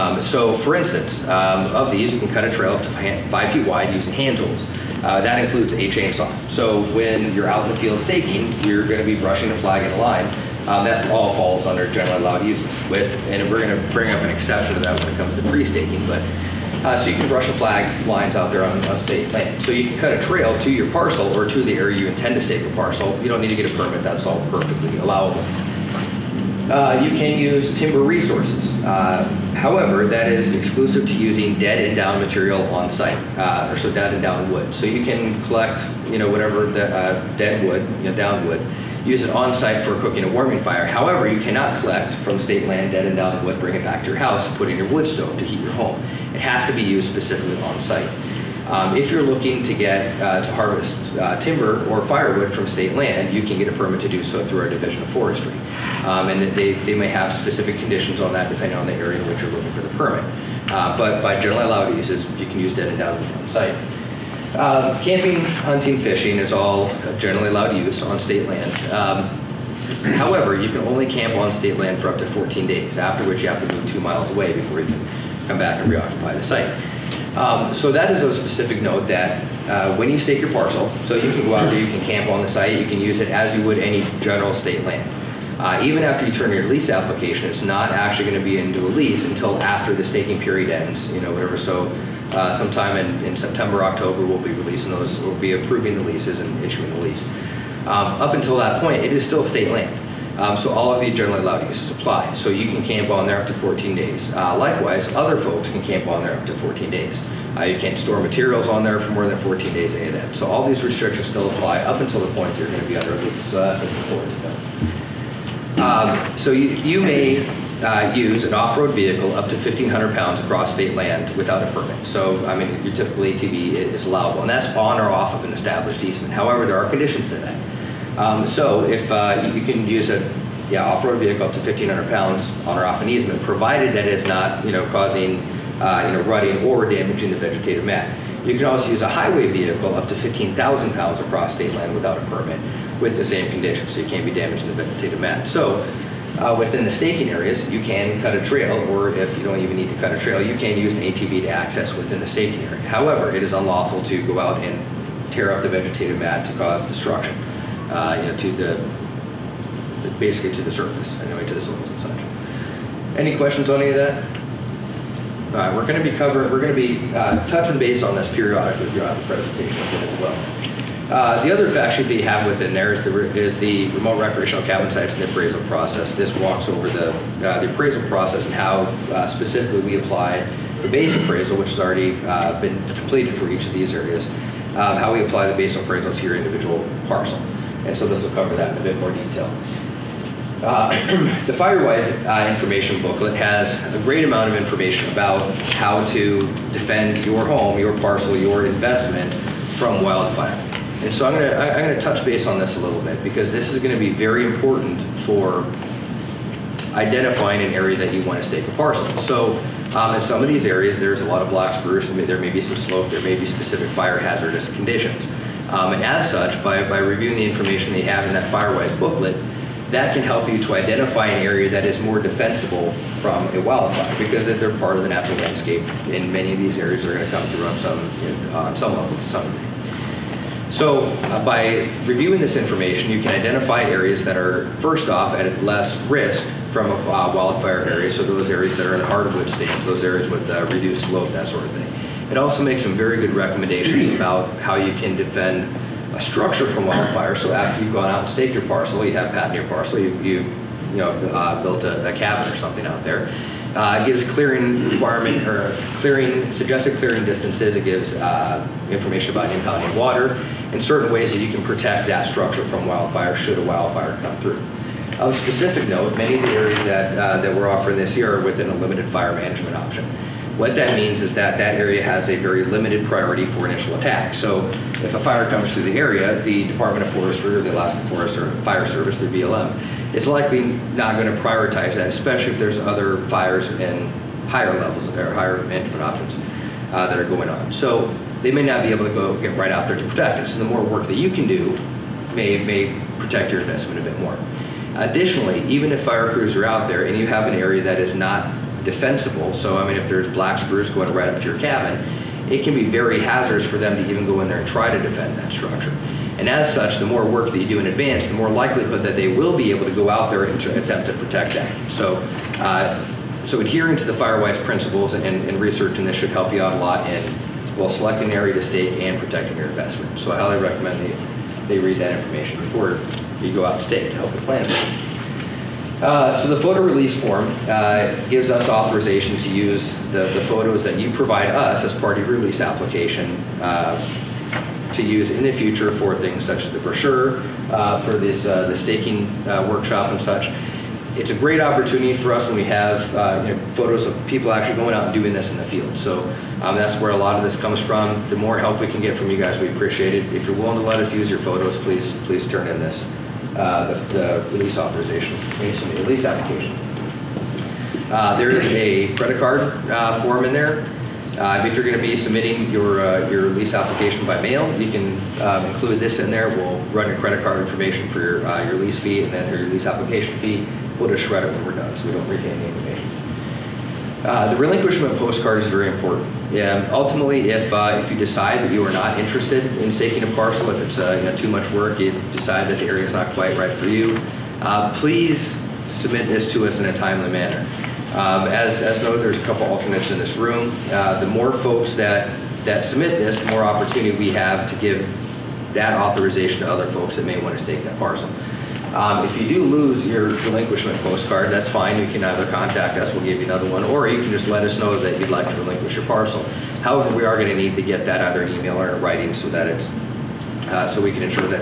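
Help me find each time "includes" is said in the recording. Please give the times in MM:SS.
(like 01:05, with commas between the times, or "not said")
00:05, 06:05.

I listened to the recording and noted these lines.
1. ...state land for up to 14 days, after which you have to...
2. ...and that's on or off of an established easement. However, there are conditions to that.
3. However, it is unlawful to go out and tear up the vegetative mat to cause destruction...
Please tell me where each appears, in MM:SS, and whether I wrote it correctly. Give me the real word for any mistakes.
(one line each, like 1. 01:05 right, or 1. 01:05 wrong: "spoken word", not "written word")
1. 01:11 right
2. 02:04 right
3. 02:32 right.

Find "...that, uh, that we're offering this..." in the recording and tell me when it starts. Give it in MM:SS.
04:26.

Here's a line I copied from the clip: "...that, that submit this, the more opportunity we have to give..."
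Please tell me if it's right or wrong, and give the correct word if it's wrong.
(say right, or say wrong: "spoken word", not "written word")
right.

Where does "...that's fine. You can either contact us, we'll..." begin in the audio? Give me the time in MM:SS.
06:41.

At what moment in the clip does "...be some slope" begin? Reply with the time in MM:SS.
03:32.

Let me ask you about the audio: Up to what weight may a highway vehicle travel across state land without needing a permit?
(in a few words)
15,000 pounds.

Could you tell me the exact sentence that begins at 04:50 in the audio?
So the more work that you can do may, may protect your investment a bit more.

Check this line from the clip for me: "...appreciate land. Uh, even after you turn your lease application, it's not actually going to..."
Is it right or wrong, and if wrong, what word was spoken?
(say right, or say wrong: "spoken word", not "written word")
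wrong: "state", not "appreciate".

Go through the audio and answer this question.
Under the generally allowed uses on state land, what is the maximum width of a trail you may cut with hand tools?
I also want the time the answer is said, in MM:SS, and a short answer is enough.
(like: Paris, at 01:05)
5 feet, at 00:03.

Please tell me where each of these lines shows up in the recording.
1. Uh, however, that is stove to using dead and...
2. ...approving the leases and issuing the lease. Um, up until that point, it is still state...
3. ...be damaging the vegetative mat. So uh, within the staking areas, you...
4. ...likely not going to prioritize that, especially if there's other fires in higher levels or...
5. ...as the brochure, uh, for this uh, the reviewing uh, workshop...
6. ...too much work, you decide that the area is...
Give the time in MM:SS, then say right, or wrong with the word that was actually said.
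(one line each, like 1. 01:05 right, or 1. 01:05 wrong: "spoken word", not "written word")
1. 00:28 wrong: "exclusive", not "stove"
2. 01:35 right
3. 02:24 right
4. 04:40 right
5. 05:36 wrong: "staking", not "reviewing"
6. 06:21 right.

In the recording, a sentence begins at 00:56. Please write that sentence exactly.
Um, and they, they may have specific conditions on that depending on the area in which you're looking for the permit.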